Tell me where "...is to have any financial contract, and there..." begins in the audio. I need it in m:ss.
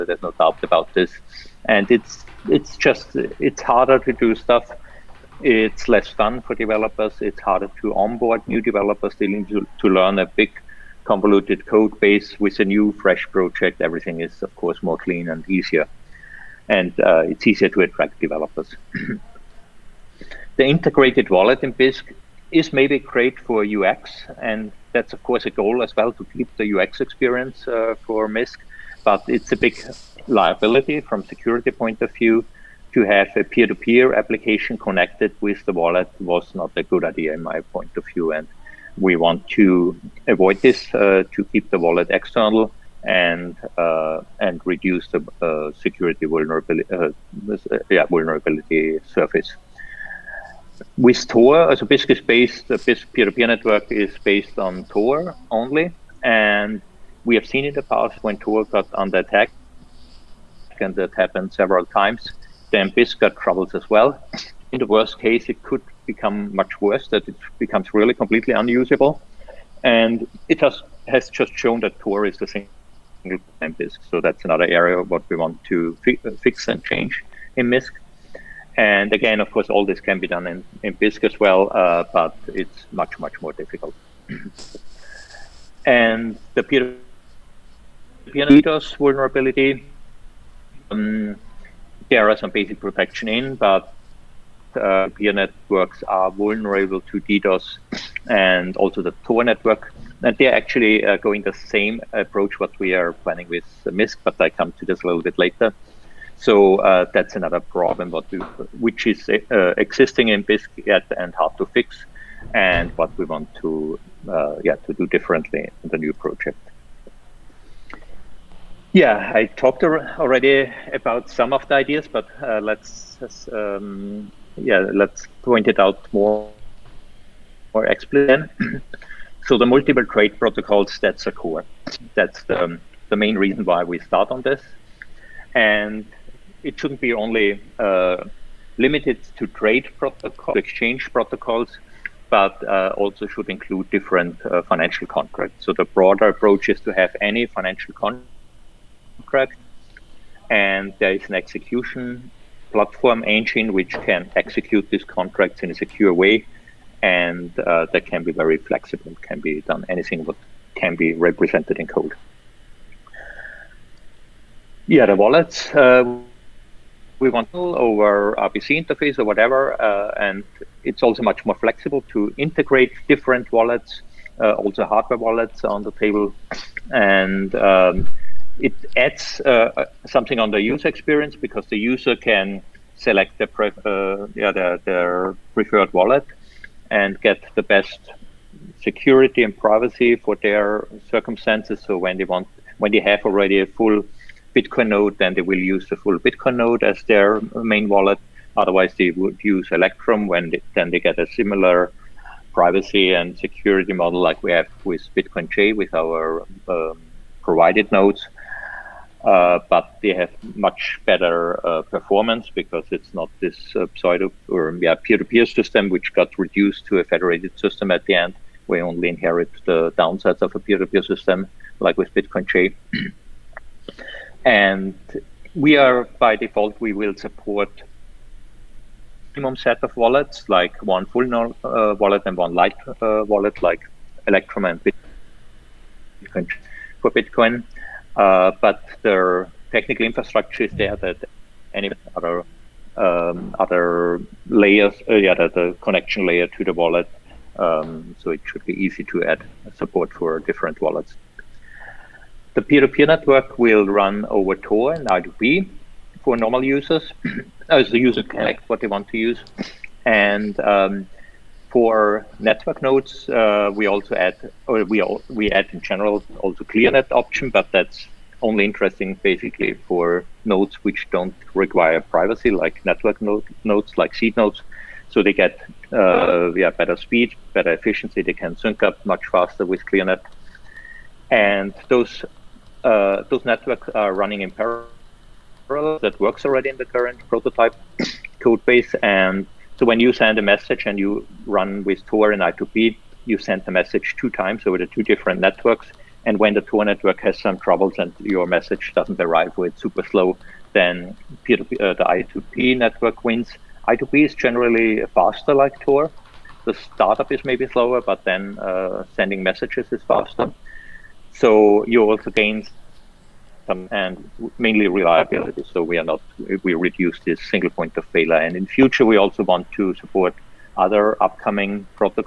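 2:26.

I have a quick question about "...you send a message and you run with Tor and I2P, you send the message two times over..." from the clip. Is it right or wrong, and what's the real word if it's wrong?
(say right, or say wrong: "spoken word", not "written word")
right.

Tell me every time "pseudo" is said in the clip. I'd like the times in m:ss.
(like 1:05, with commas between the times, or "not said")
3:33.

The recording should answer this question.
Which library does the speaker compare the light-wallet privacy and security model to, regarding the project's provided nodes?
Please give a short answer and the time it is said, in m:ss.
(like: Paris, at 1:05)
BitcoinJ, at 3:25.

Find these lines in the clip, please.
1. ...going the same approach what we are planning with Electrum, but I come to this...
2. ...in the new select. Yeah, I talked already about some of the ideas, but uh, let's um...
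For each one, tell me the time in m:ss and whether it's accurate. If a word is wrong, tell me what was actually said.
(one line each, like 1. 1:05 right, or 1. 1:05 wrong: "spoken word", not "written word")
1. 1:41 wrong: "Misq", not "Electrum"
2. 1:55 wrong: "project", not "select".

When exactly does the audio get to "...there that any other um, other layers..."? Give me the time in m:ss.
4:00.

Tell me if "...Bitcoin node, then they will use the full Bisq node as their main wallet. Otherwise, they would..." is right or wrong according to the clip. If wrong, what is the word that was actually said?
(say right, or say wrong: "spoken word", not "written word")
wrong: "Bitcoin", not "Bisq".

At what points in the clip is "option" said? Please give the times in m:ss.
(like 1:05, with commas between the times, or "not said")
4:27.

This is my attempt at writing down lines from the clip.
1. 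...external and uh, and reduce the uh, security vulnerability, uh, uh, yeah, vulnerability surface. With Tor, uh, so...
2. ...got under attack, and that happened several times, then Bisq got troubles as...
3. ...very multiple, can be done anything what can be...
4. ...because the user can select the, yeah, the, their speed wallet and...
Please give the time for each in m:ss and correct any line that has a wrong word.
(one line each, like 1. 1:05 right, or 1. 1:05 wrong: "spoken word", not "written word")
1. 0:42 right
2. 0:58 right
3. 2:38 wrong: "flexible", not "multiple"
4. 3:01 wrong: "preferred", not "speed".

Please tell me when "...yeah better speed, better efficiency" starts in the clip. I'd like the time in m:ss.
4:36.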